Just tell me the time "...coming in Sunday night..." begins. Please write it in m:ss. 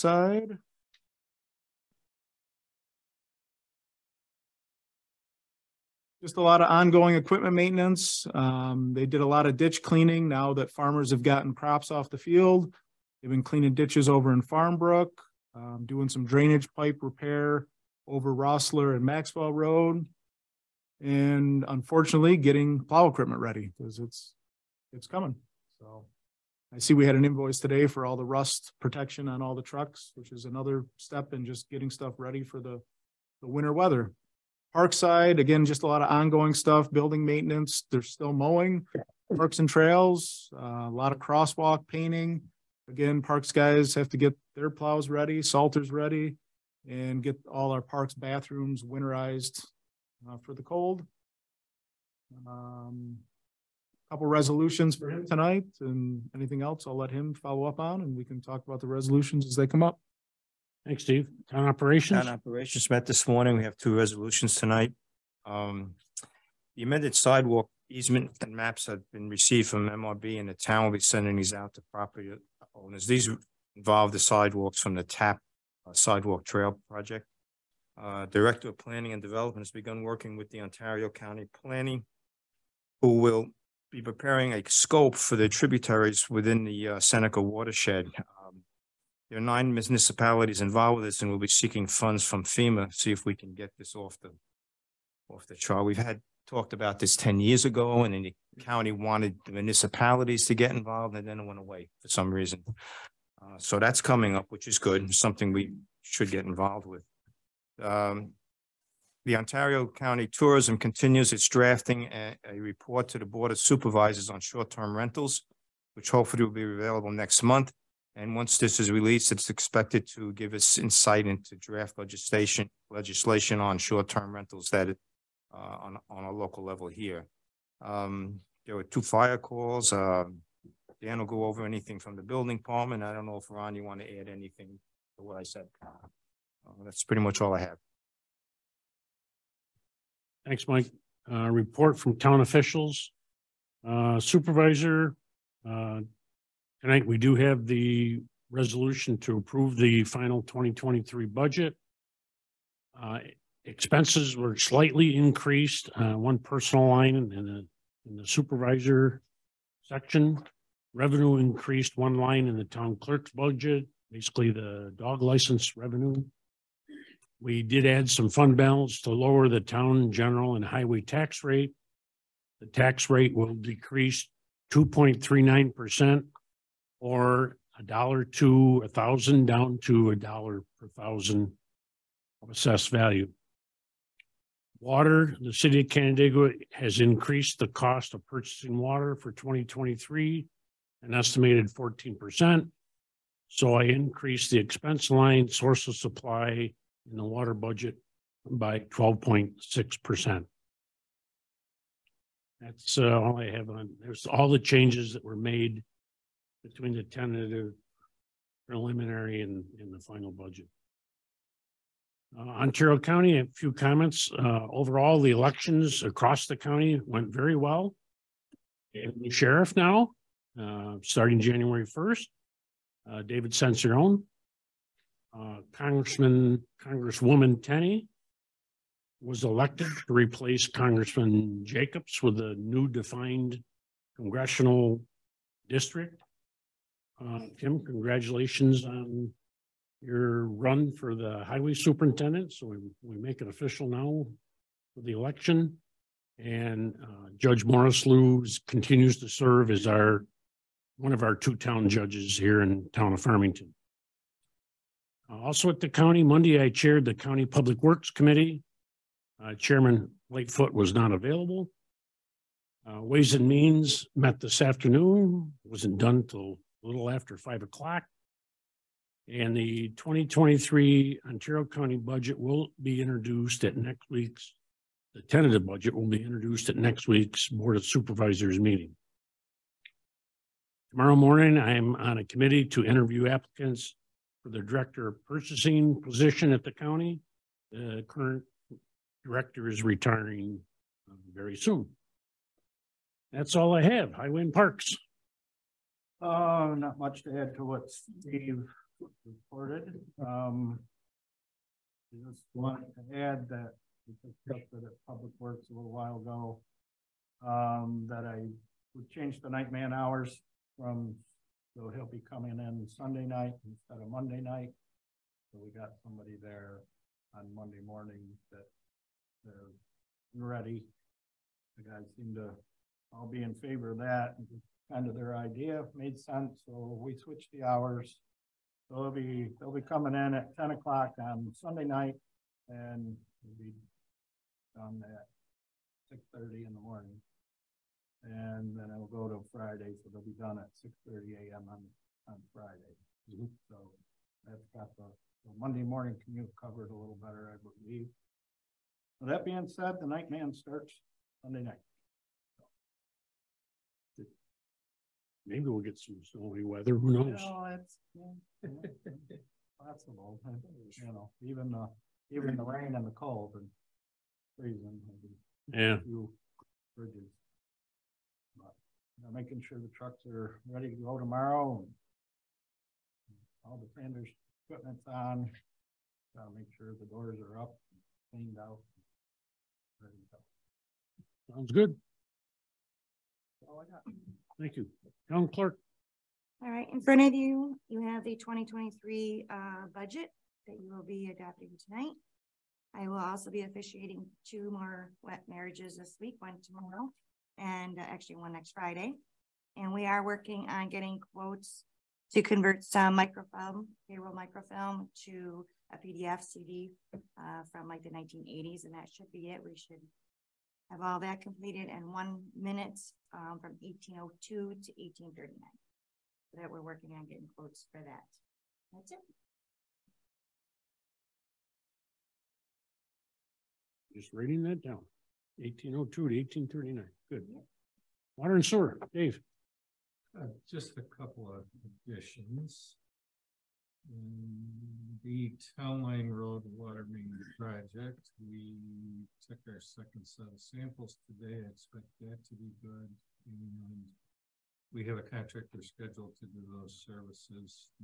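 5:12.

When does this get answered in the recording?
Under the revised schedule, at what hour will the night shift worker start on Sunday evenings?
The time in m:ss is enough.
5:30.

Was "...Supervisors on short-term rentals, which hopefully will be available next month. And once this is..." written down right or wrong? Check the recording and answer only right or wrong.
right.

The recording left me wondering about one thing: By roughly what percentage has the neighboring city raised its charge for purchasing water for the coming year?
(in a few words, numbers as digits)
14%.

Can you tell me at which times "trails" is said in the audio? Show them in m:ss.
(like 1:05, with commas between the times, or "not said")
0:39, 1:16.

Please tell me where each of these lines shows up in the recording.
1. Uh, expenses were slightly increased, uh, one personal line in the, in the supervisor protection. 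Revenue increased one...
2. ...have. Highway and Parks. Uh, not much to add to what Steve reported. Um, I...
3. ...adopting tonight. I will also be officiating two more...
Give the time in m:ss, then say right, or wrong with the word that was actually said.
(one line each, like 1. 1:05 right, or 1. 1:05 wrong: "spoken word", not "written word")
1. 2:32 wrong: "section", not "protection"
2. 4:53 right
3. 6:31 right.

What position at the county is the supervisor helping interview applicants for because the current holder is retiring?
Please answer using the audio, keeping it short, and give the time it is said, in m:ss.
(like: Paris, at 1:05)
director of purchasing, at 4:44.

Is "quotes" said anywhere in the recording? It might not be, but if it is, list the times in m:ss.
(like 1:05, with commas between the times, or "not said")
6:41, 6:57.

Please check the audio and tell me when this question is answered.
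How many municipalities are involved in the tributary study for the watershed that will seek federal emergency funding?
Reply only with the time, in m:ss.
1:29.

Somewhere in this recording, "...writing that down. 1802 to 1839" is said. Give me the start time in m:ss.
7:04.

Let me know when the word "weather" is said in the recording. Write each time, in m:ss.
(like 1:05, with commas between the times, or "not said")
0:33, 5:56.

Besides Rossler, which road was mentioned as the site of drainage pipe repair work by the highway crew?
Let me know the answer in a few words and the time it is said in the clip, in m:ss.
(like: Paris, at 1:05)
Maxwell Road, at 0:19.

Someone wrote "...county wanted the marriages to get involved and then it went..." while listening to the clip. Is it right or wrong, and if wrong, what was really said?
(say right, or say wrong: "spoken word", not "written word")
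wrong: "municipalities", not "marriages".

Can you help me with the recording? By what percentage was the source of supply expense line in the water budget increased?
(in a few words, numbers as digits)
12.6%.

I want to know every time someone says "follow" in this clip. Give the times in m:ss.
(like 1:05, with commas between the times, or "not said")
0:57.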